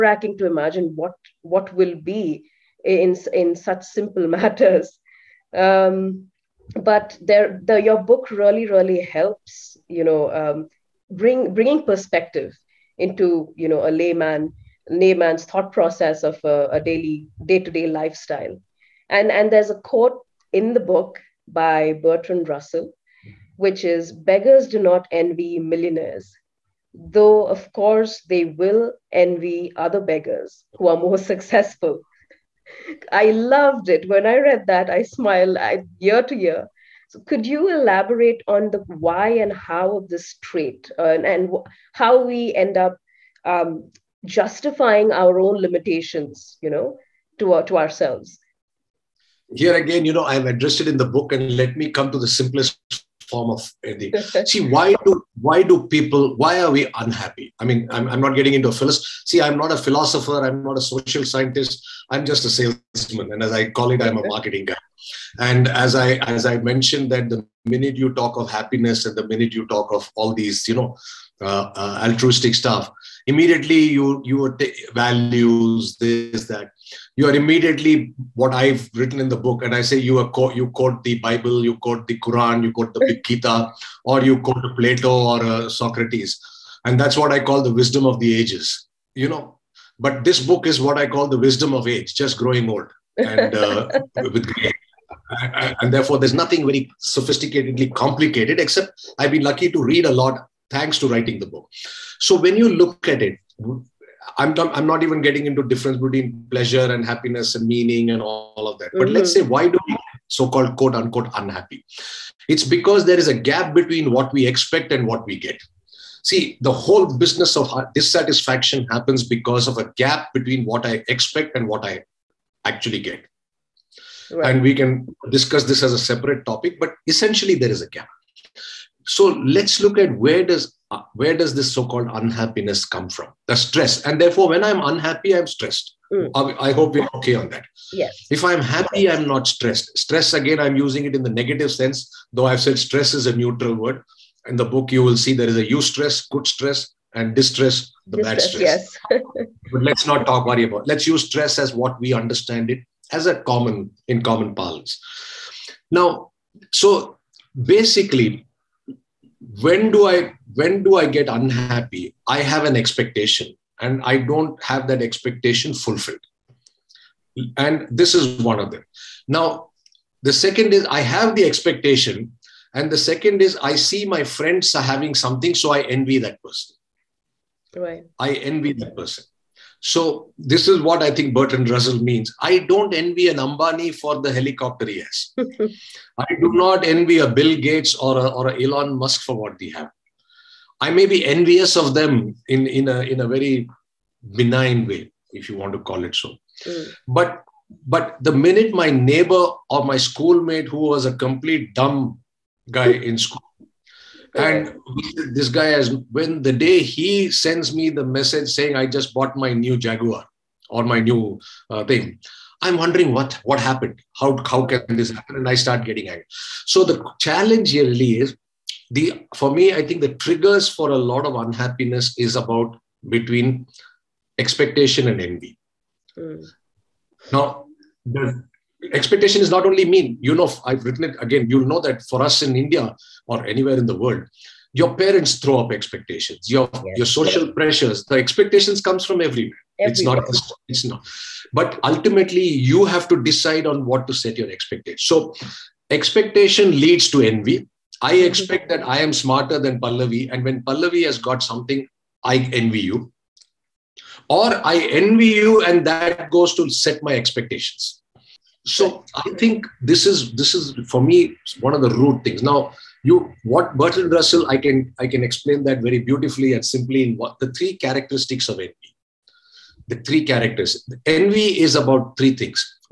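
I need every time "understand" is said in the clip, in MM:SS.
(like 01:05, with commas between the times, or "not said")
02:32.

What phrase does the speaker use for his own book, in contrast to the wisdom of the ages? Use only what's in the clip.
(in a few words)
wisdom of age.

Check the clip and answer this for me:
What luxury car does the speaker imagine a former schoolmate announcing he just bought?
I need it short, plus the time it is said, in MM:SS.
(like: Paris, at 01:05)
Jaguar, at 03:29.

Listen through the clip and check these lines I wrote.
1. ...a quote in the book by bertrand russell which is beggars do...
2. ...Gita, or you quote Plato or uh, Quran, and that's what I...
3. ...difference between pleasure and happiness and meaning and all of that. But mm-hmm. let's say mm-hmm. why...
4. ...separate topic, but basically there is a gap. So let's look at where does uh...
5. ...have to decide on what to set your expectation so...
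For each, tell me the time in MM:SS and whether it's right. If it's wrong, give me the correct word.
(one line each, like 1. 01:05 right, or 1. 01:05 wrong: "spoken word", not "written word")
1. 00:19 right
2. 01:23 wrong: "Socrates", not "Quran"
3. 01:45 right
4. 02:05 wrong: "essentially", not "basically"
5. 04:02 right.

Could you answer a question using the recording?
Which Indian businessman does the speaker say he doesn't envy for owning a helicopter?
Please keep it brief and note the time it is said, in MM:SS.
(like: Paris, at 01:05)
Ambani, at 03:03.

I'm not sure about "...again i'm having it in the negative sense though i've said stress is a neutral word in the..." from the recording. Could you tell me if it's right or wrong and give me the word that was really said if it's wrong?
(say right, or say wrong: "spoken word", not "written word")
wrong: "using", not "having".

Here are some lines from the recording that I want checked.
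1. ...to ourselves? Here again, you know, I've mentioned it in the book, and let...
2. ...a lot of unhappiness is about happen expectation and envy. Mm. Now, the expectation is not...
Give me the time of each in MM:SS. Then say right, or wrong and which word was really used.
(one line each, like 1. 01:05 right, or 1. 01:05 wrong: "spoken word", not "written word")
1. 00:47 wrong: "addressed", not "mentioned"
2. 03:40 wrong: "between", not "happen".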